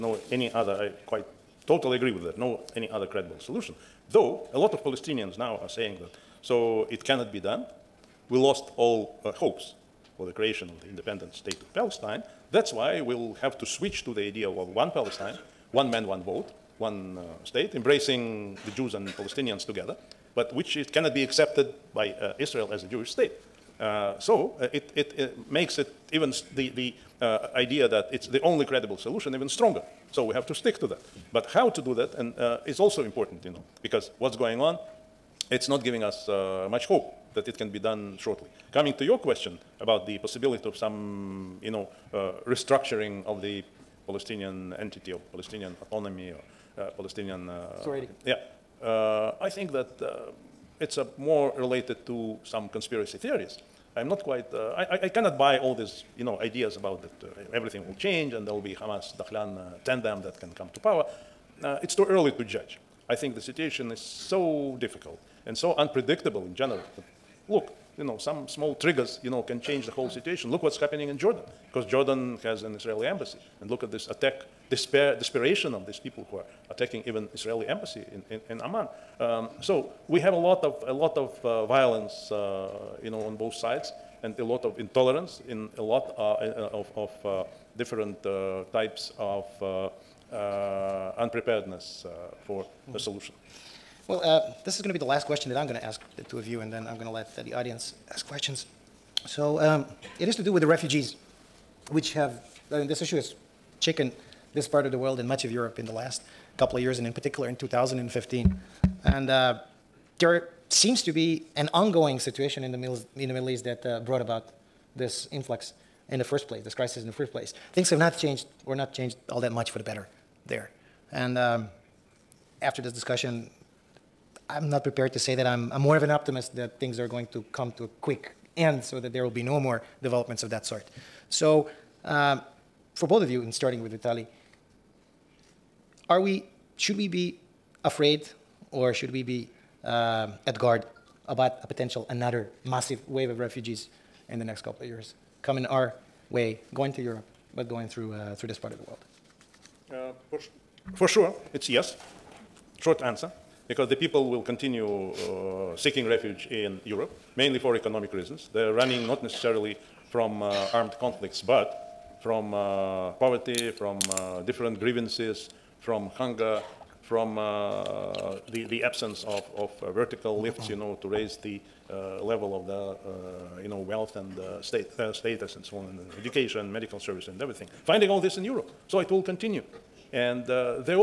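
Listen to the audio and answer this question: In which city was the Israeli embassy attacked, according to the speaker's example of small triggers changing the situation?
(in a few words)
Amman.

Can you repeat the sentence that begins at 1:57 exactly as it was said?
Things have not changed we're not changed all that much for the better there.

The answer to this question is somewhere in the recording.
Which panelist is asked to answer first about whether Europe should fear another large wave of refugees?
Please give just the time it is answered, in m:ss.
2:13.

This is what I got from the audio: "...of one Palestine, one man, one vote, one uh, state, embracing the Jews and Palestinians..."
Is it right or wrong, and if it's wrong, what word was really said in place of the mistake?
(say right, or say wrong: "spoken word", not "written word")
right.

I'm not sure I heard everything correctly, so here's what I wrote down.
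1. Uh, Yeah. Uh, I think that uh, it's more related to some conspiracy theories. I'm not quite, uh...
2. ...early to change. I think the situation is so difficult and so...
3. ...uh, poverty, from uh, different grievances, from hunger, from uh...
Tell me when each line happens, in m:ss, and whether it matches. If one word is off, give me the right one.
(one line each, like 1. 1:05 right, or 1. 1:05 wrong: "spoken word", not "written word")
1. 0:47 right
2. 1:02 wrong: "judge", not "change"
3. 2:42 right.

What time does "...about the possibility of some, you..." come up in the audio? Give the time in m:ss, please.
0:39.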